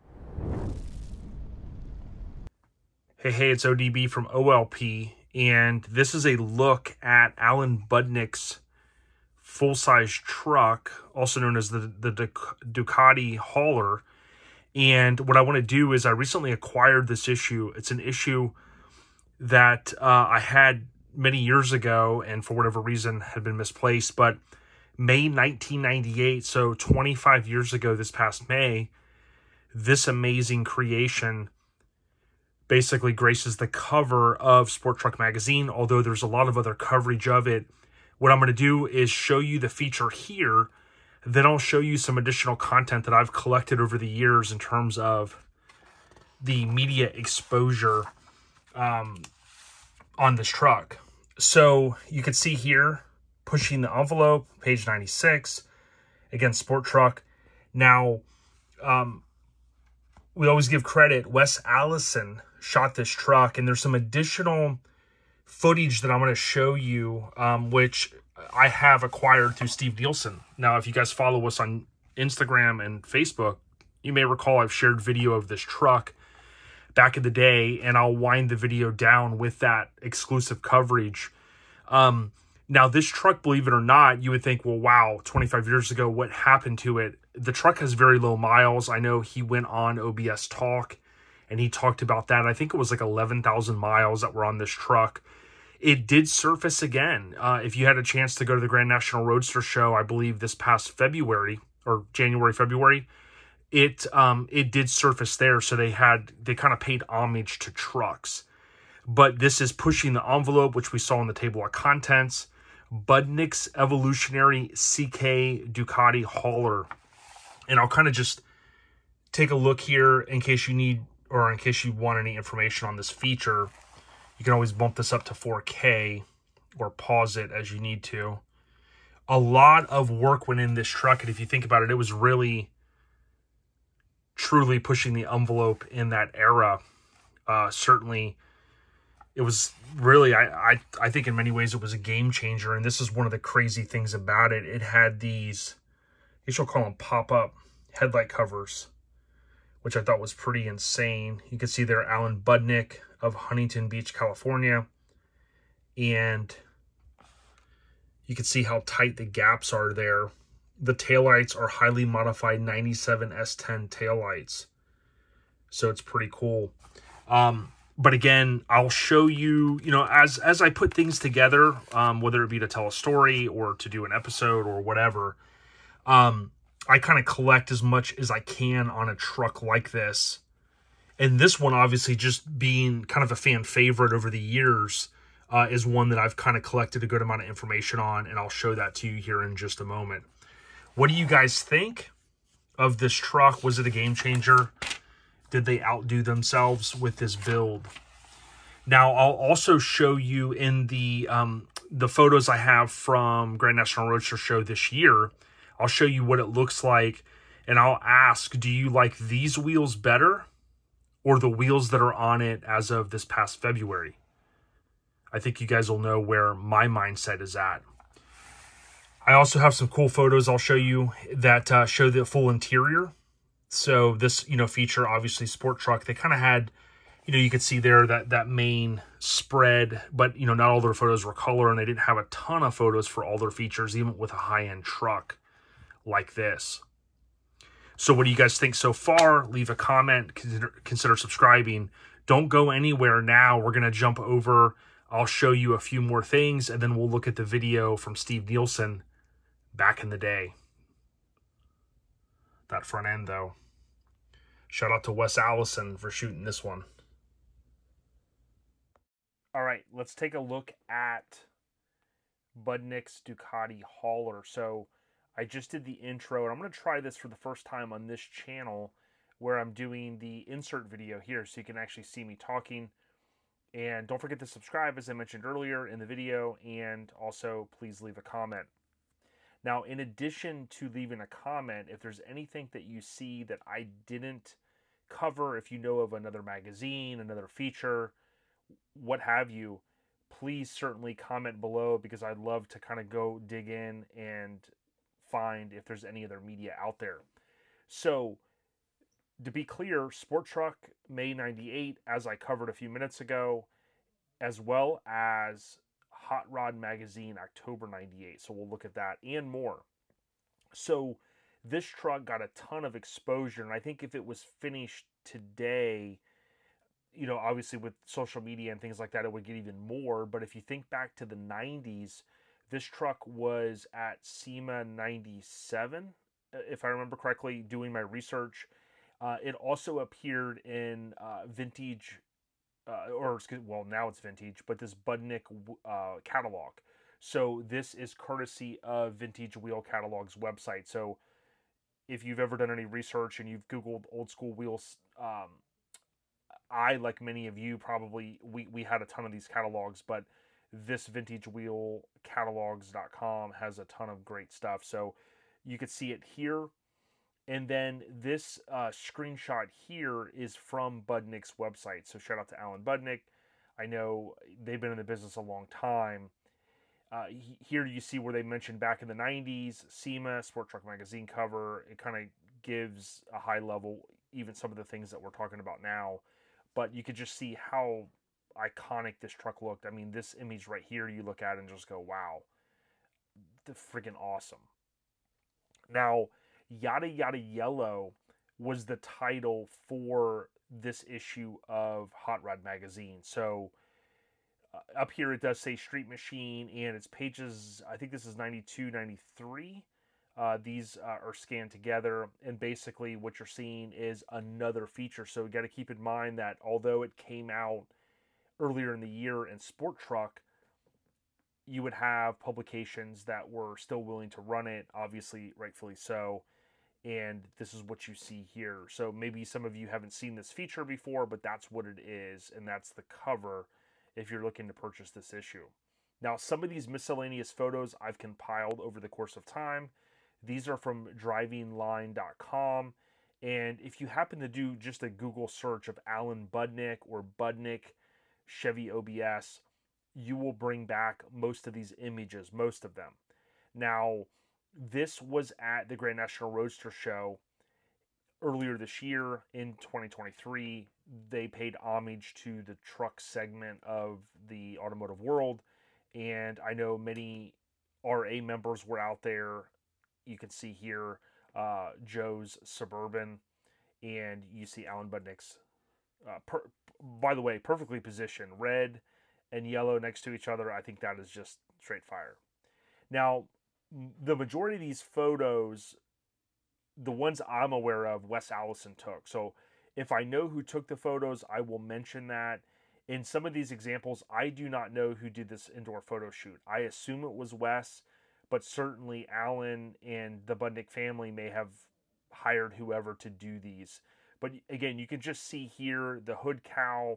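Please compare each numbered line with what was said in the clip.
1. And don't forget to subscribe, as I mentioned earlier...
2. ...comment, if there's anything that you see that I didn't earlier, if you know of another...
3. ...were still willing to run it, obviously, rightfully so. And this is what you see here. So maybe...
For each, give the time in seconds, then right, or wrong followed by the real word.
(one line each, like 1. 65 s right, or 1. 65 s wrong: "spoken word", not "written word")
1. 273 s right
2. 281 s wrong: "cover", not "earlier"
3. 413 s right.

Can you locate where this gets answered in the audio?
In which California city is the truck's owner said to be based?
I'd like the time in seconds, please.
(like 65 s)
153 s.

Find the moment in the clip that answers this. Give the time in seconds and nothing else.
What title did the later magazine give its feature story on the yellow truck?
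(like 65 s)
386 s.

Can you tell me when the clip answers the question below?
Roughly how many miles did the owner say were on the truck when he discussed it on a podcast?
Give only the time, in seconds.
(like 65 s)
92 s.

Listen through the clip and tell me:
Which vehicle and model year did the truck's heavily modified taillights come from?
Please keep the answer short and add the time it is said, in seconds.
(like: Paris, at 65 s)
97 S10, at 162 s.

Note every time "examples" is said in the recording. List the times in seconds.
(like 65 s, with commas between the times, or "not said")
483 s.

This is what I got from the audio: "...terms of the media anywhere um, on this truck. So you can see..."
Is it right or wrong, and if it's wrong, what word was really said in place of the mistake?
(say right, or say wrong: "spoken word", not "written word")
wrong: "exposure", not "anywhere".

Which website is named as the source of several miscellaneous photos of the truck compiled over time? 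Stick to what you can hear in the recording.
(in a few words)
drivingline.com.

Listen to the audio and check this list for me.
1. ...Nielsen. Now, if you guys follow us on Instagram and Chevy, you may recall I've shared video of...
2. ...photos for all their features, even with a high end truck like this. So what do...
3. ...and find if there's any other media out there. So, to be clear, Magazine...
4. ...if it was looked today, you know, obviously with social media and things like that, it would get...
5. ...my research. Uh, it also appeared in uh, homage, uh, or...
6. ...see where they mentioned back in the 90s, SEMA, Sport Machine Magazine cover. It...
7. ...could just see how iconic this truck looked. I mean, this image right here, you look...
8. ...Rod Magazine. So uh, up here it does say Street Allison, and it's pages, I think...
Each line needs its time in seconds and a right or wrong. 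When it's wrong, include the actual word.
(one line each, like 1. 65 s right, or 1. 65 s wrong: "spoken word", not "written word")
1. 69 s wrong: "Facebook", not "Chevy"
2. 232 s right
3. 294 s wrong: "Sport", not "Magazine"
4. 314 s wrong: "finished", not "looked"
5. 327 s wrong: "vintage", not "homage"
6. 367 s wrong: "Truck", not "Machine"
7. 377 s right
8. 392 s wrong: "Machine", not "Allison".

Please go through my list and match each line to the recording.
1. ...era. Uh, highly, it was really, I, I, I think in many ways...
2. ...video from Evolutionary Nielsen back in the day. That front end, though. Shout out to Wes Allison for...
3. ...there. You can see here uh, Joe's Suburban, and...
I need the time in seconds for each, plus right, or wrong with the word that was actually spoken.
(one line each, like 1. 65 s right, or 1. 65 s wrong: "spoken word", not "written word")
1. 136 s wrong: "certainly", not "highly"
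2. 247 s wrong: "Steve", not "Evolutionary"
3. 459 s right.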